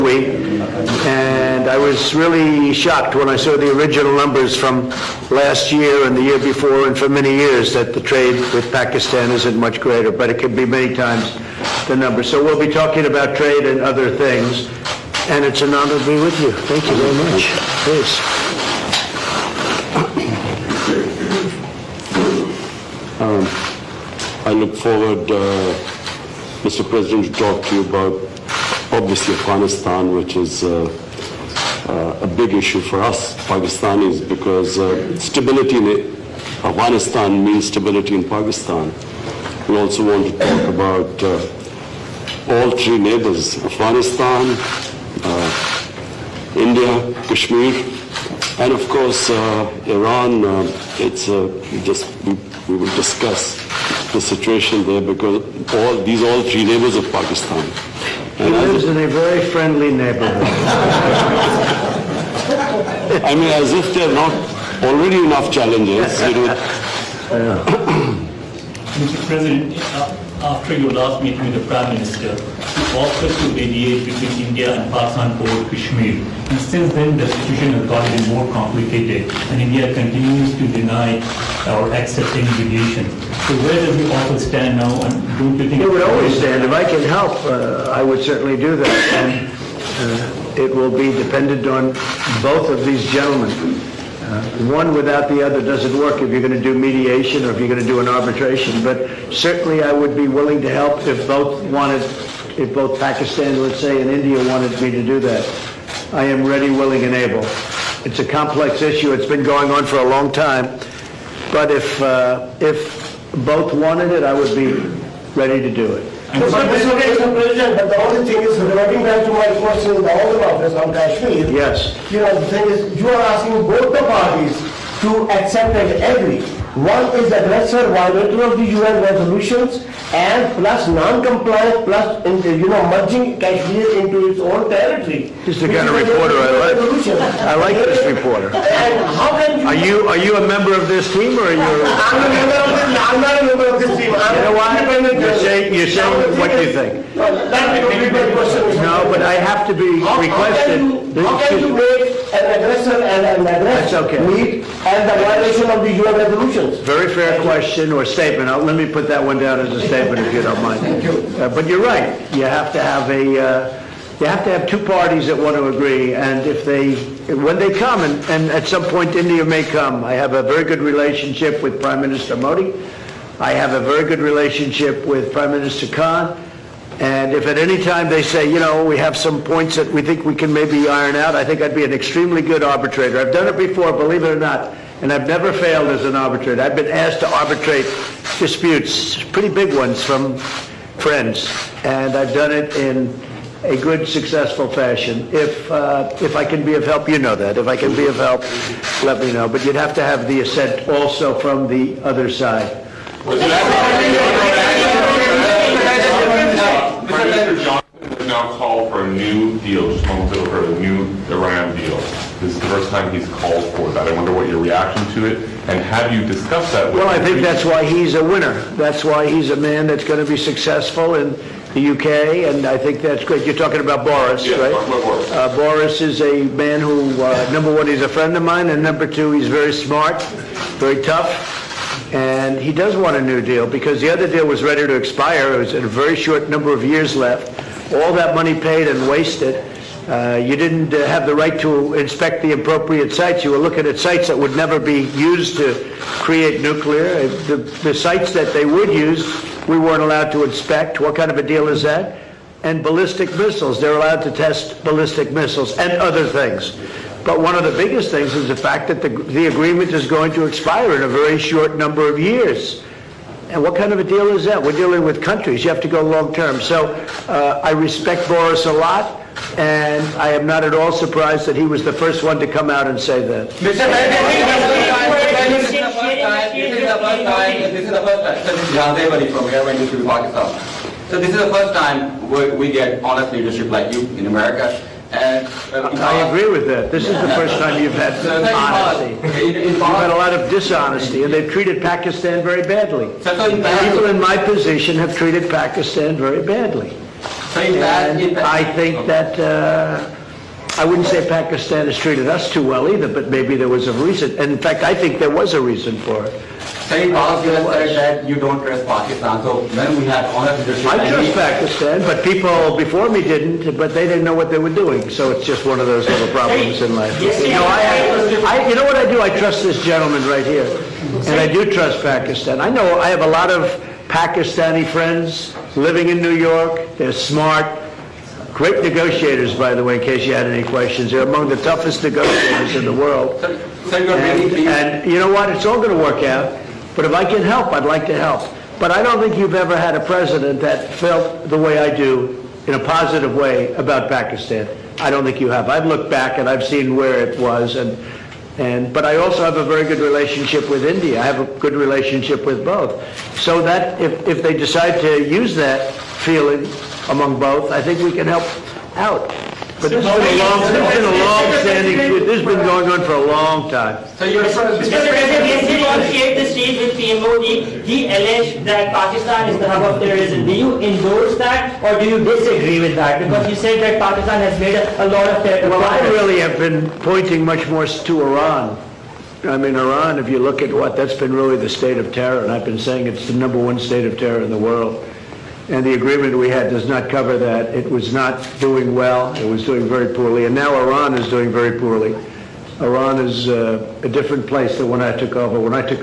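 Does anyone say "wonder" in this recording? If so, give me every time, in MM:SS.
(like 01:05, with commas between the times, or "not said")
03:34.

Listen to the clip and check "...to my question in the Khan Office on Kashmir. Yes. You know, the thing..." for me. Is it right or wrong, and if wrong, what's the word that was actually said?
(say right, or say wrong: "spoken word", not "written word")
wrong: "House", not "Khan".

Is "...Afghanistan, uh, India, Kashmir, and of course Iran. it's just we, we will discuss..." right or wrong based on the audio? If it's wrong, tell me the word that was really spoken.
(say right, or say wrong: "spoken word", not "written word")
right.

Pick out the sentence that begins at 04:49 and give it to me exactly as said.
you've had a lot of dishonesty, and they've treated Pakistan very badly.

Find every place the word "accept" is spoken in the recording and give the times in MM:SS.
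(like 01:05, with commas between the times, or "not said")
01:21, 02:05.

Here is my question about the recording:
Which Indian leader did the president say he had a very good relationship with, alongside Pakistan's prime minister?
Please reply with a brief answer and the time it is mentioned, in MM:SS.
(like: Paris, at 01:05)
Prime Minister Modi, at 02:51.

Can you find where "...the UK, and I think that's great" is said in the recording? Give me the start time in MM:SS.
03:41.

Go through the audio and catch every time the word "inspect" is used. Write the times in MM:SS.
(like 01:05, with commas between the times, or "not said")
04:01, 04:10.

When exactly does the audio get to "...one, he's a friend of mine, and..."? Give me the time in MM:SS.
03:47.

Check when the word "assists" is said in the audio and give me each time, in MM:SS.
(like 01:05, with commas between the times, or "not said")
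not said.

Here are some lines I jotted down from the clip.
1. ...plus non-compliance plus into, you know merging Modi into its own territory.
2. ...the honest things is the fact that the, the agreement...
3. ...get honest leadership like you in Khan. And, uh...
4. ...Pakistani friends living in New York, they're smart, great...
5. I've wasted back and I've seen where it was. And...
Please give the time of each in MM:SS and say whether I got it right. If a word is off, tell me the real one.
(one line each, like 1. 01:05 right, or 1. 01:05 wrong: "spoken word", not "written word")
1. 02:10 wrong: "Kashmir", not "Modi"
2. 04:17 wrong: "biggest", not "honest"
3. 04:42 wrong: "America", not "Khan"
4. 05:24 right
5. 05:45 wrong: "looked", not "wasted".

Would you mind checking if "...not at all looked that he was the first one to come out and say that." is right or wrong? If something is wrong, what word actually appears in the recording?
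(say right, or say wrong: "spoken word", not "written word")
wrong: "surprised", not "looked".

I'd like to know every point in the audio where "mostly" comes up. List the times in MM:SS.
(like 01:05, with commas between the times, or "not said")
not said.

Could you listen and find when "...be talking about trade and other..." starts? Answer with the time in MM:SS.
00:12.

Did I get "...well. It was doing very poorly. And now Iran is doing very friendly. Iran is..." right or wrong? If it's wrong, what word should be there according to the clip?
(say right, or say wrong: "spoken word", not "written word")
wrong: "poorly", not "friendly".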